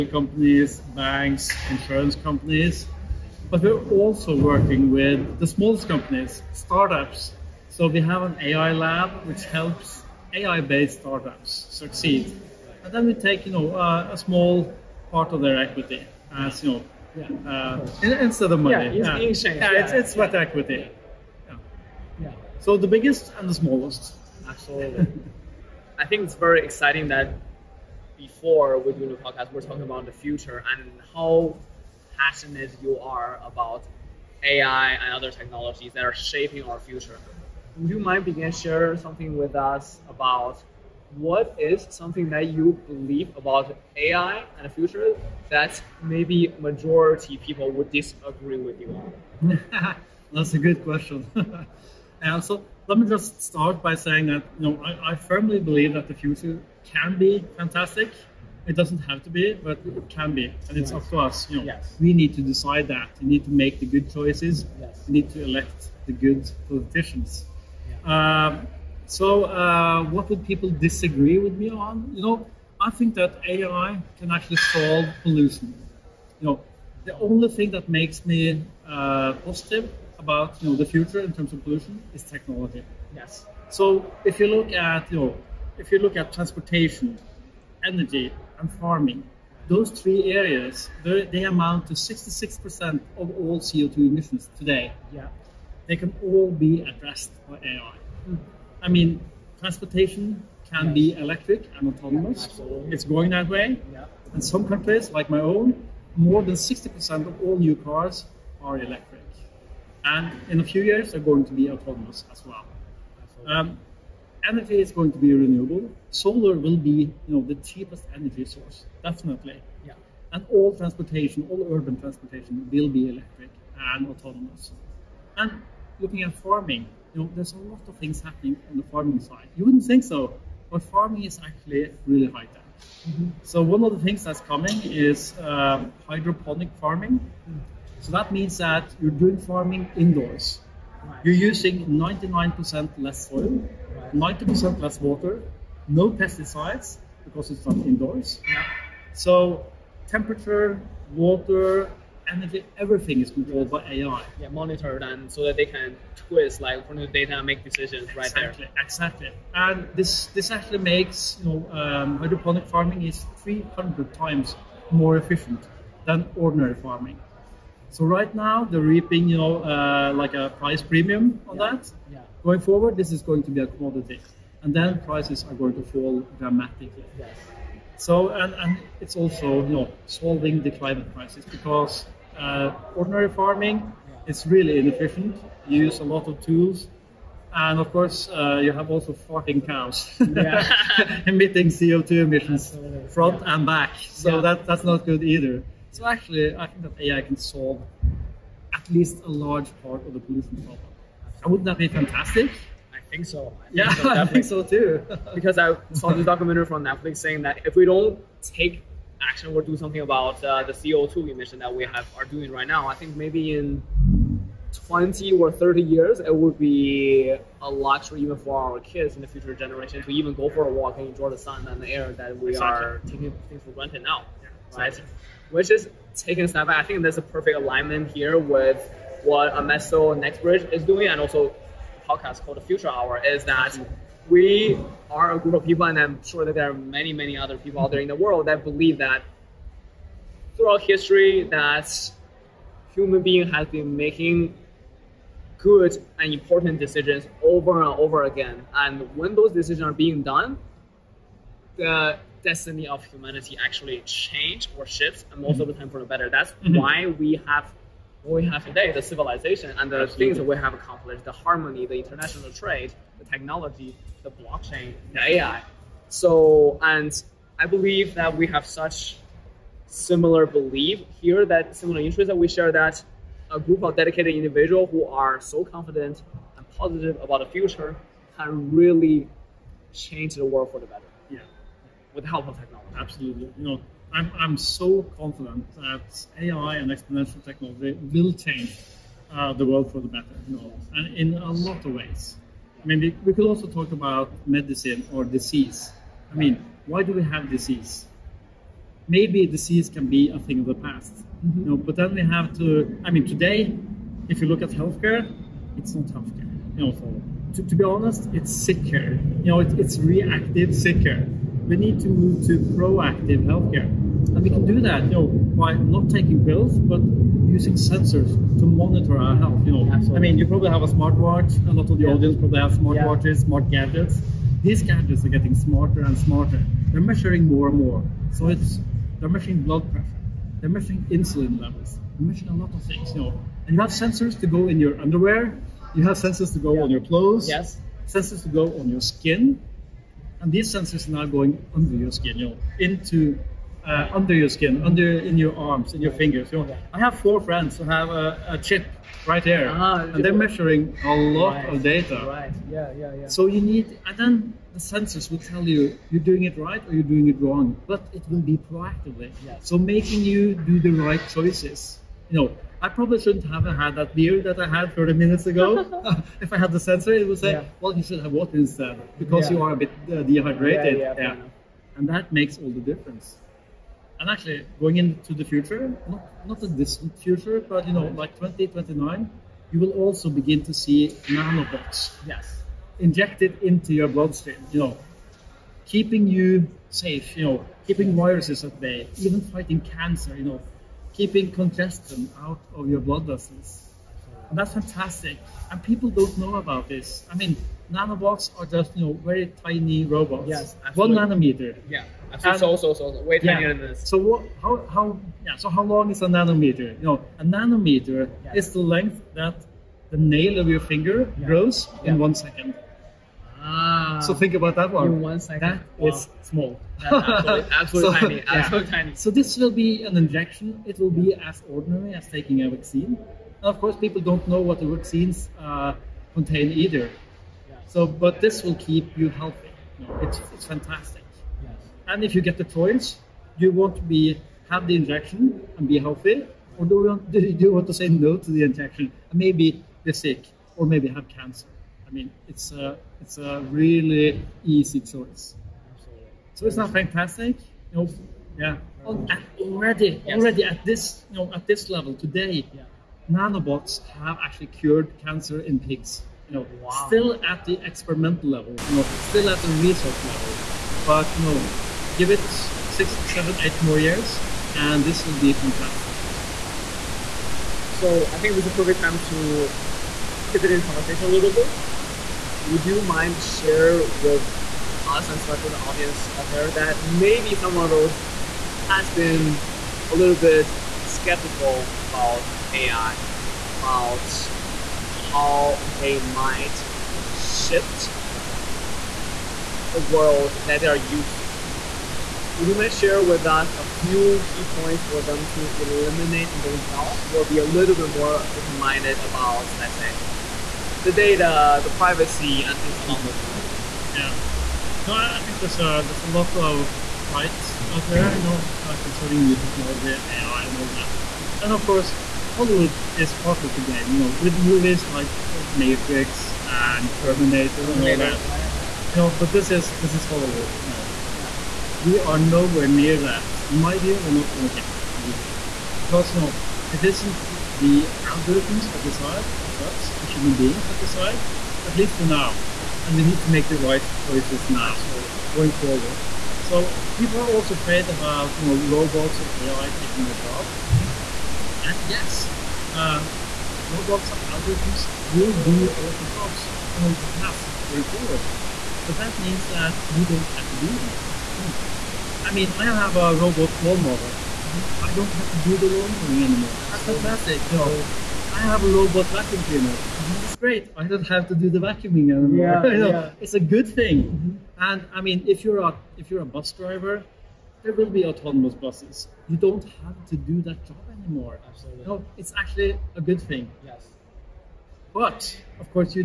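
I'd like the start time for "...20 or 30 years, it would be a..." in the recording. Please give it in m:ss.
3:34.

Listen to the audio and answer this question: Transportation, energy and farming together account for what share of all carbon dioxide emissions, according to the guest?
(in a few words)
66%.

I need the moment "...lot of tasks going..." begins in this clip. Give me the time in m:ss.
9:07.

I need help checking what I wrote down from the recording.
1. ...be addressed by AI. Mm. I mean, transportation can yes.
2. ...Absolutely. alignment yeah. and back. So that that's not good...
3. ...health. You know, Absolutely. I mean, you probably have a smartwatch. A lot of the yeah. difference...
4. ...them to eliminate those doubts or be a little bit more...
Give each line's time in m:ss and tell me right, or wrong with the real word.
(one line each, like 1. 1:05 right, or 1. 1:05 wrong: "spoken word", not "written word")
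1. 1:36 right
2. 3:12 wrong: "front", not "alignment"
3. 5:19 wrong: "audience", not "difference"
4. 8:15 right.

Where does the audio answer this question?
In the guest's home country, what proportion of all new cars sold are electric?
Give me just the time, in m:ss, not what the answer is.
1:46.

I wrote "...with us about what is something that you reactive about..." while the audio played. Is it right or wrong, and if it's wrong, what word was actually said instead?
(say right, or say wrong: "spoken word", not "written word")
wrong: "believe", not "reactive".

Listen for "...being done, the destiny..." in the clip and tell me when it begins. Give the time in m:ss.
4:09.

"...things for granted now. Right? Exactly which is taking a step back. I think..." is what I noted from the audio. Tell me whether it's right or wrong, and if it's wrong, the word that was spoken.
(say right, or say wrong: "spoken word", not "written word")
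right.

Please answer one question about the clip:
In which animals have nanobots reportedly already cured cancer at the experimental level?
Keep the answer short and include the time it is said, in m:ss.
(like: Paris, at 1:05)
pigs, at 7:35.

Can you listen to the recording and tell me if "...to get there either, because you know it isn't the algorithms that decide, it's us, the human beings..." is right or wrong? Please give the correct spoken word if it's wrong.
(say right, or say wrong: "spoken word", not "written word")
right.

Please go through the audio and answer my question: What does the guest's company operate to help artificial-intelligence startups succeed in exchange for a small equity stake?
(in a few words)
AI lab.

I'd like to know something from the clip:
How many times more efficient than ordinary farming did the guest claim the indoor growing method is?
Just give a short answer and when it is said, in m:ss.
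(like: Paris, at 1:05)
300, at 2:43.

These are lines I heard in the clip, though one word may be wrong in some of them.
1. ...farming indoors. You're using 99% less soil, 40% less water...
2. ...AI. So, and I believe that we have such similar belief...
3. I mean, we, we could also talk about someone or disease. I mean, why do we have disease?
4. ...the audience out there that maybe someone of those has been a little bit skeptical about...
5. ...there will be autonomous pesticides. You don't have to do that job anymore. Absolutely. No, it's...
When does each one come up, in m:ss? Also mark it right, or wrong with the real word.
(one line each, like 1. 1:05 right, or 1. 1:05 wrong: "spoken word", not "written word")
1. 2:19 wrong: "90", not "40"
2. 4:25 right
3. 4:52 wrong: "medicine", not "someone"
4. 7:55 right
5. 9:27 wrong: "buses", not "pesticides".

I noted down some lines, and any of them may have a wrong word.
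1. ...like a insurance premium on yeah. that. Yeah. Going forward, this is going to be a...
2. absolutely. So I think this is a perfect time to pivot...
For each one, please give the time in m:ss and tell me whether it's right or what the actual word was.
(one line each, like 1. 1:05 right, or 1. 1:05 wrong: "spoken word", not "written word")
1. 2:50 wrong: "price", not "insurance"
2. 7:46 right.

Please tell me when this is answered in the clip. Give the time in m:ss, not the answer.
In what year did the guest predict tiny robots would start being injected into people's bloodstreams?
6:18.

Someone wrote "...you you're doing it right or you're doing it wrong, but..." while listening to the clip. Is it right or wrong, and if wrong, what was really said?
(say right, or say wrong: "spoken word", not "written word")
right.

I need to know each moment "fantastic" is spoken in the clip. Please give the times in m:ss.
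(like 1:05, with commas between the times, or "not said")
0:57, 3:21, 6:34, 7:10, 7:26, 7:45, 9:17.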